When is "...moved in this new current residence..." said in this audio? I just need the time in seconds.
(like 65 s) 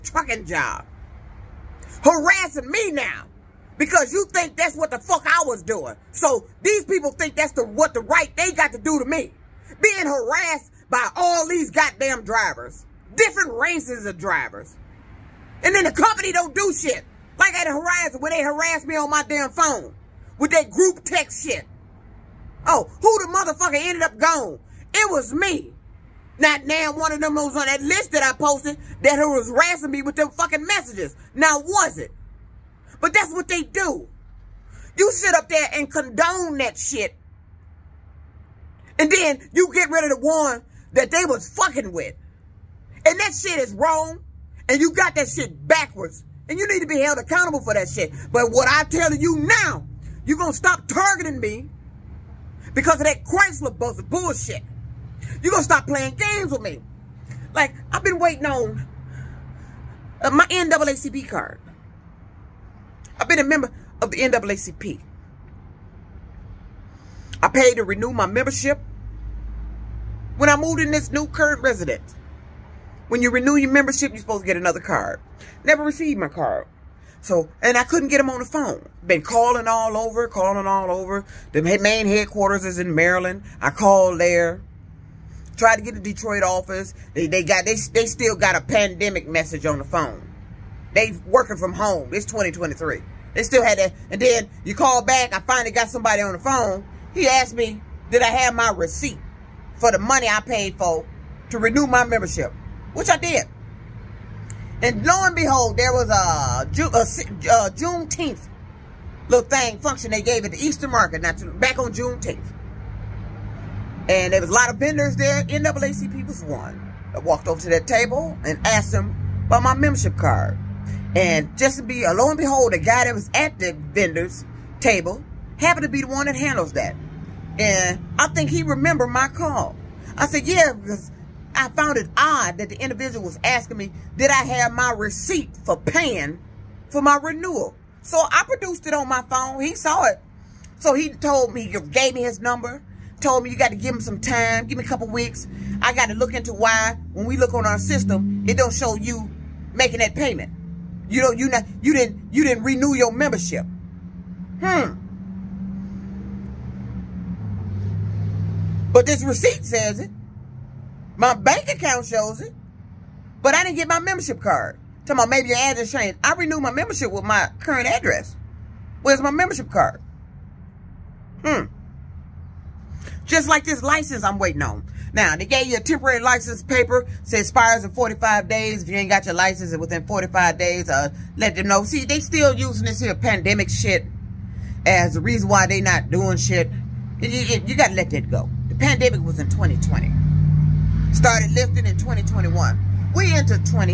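70 s.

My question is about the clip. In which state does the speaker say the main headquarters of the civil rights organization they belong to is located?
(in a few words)
Maryland.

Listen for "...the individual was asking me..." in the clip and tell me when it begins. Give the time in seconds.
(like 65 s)
132 s.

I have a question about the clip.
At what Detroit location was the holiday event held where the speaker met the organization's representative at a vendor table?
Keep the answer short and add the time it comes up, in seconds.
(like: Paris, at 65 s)
Eastern Market, at 110 s.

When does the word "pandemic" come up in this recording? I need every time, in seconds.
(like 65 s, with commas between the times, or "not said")
88 s, 183 s, 188 s.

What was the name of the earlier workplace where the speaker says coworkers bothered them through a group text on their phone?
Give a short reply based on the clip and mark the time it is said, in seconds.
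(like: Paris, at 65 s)
Horizon, at 17 s.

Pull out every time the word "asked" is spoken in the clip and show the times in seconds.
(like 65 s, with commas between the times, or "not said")
97 s, 118 s.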